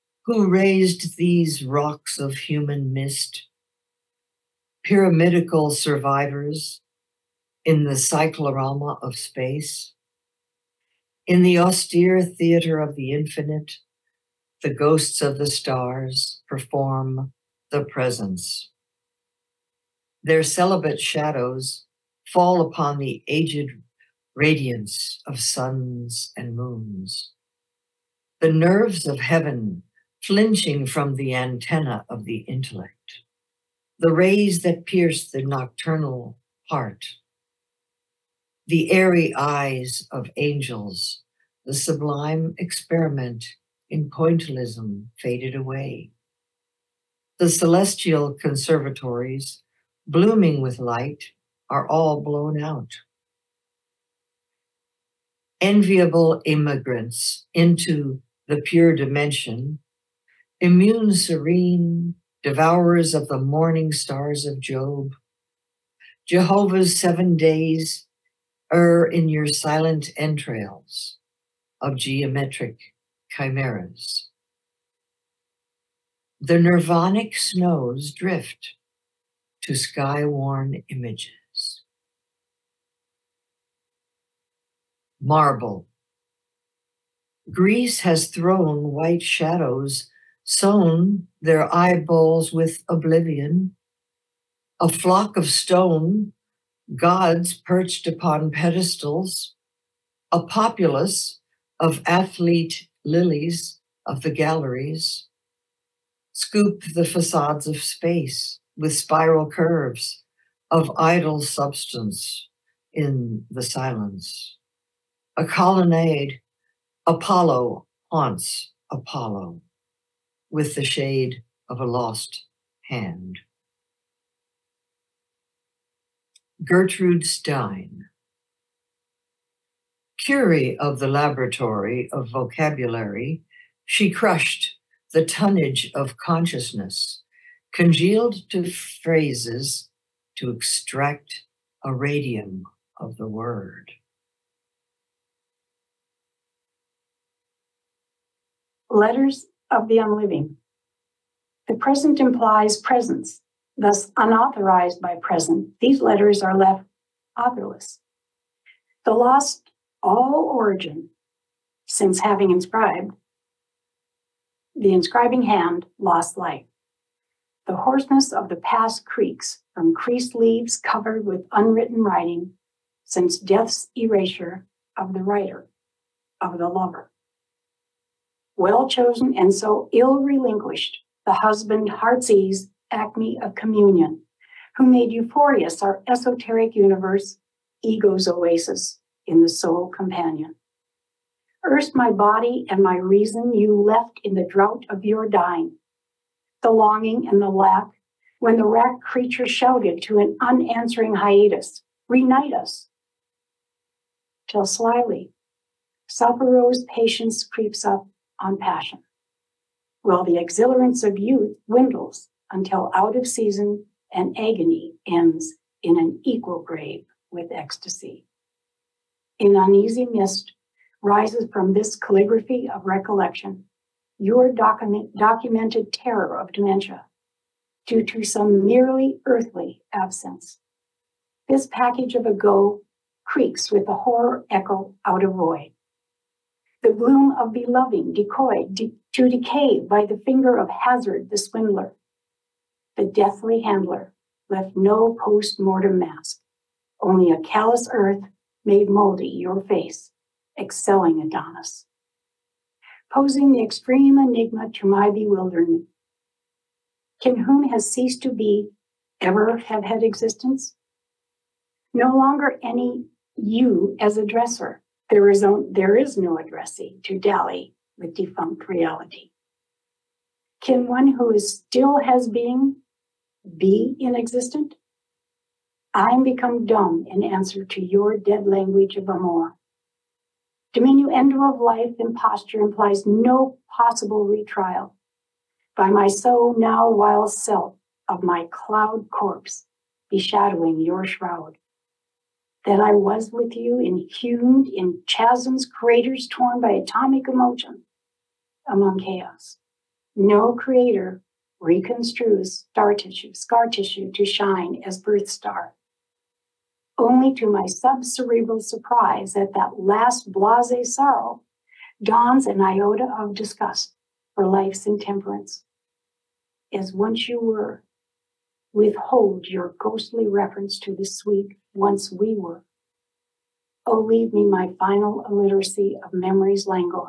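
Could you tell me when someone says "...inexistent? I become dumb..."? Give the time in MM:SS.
04:33.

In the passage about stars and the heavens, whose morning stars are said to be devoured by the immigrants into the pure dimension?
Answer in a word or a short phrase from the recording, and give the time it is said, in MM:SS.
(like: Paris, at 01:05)
Job, at 01:04.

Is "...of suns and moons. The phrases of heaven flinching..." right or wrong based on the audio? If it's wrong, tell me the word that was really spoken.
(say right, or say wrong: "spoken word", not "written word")
wrong: "nerves", not "phrases".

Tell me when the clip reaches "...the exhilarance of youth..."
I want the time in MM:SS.
03:30.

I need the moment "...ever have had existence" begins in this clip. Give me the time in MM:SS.
04:19.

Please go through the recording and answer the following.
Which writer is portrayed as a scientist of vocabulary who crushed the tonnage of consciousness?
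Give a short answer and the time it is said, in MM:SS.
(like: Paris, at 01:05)
Gertrude Stein, at 02:06.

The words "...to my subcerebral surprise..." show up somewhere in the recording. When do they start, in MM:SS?
05:07.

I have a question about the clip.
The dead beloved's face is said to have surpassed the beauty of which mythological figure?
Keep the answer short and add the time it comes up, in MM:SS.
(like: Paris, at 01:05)
Adonis, at 04:11.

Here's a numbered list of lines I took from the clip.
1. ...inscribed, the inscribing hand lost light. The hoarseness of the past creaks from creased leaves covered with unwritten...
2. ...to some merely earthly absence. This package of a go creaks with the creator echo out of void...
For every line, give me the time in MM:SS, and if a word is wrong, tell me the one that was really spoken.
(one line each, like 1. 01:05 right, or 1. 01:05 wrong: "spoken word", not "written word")
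1. 02:42 right
2. 03:48 wrong: "horror", not "creator".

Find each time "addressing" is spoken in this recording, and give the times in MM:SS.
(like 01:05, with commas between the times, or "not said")
04:26.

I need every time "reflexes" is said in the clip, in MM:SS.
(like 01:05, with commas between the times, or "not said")
not said.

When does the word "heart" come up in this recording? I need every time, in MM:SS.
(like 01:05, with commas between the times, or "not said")
00:36, 03:01.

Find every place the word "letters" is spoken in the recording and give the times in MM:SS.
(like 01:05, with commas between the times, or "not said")
02:28, 02:35.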